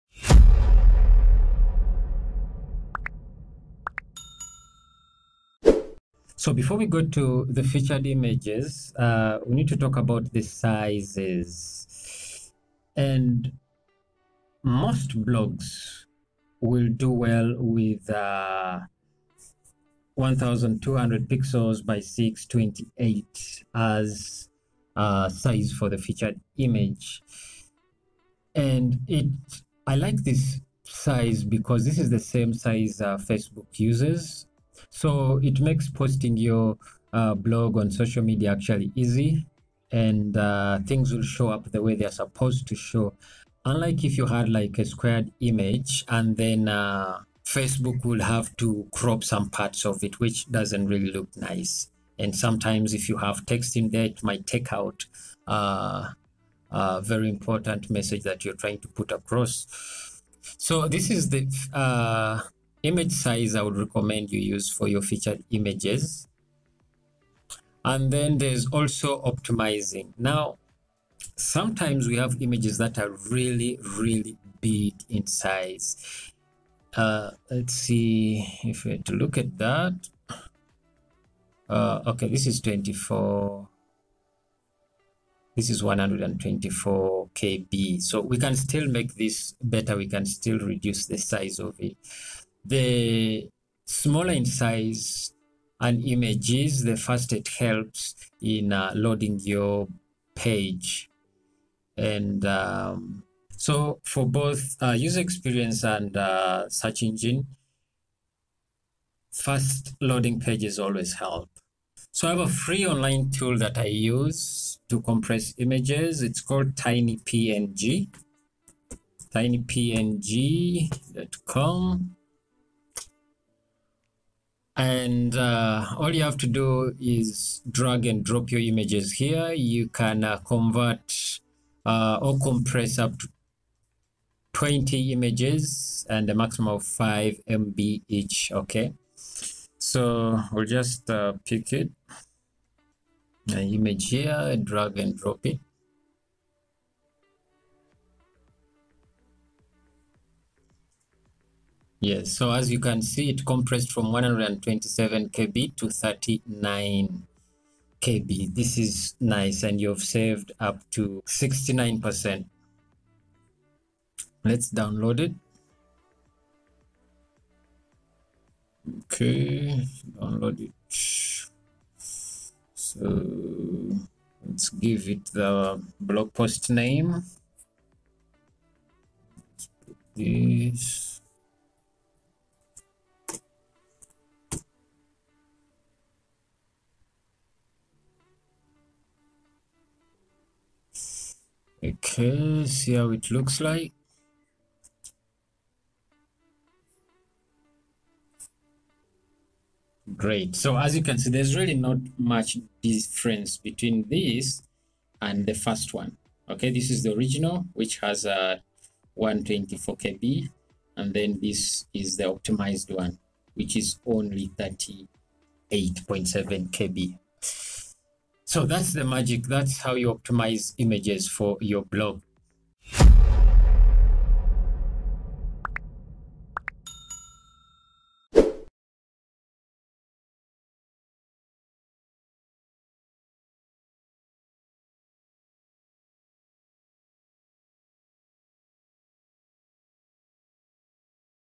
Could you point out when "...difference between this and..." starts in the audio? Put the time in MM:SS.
03:22.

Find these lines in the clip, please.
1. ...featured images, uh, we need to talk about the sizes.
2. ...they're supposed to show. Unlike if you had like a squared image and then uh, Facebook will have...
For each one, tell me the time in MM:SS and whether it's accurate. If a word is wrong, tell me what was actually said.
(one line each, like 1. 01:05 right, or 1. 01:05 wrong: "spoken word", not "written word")
1. 00:07 right
2. 00:41 right.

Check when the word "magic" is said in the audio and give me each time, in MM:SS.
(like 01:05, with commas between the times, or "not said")
03:39.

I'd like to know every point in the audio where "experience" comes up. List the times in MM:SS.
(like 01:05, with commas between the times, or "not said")
01:45.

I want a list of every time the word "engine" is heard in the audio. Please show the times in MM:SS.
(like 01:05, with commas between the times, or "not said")
01:47.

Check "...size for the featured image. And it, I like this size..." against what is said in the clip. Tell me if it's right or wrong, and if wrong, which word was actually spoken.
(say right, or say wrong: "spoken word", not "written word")
right.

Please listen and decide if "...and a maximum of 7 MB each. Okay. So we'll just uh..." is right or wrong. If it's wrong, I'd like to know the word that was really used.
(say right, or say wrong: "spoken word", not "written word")
wrong: "5", not "7".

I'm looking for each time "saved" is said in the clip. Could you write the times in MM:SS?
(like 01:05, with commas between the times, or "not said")
02:40.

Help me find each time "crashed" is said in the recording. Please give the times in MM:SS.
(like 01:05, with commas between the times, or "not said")
not said.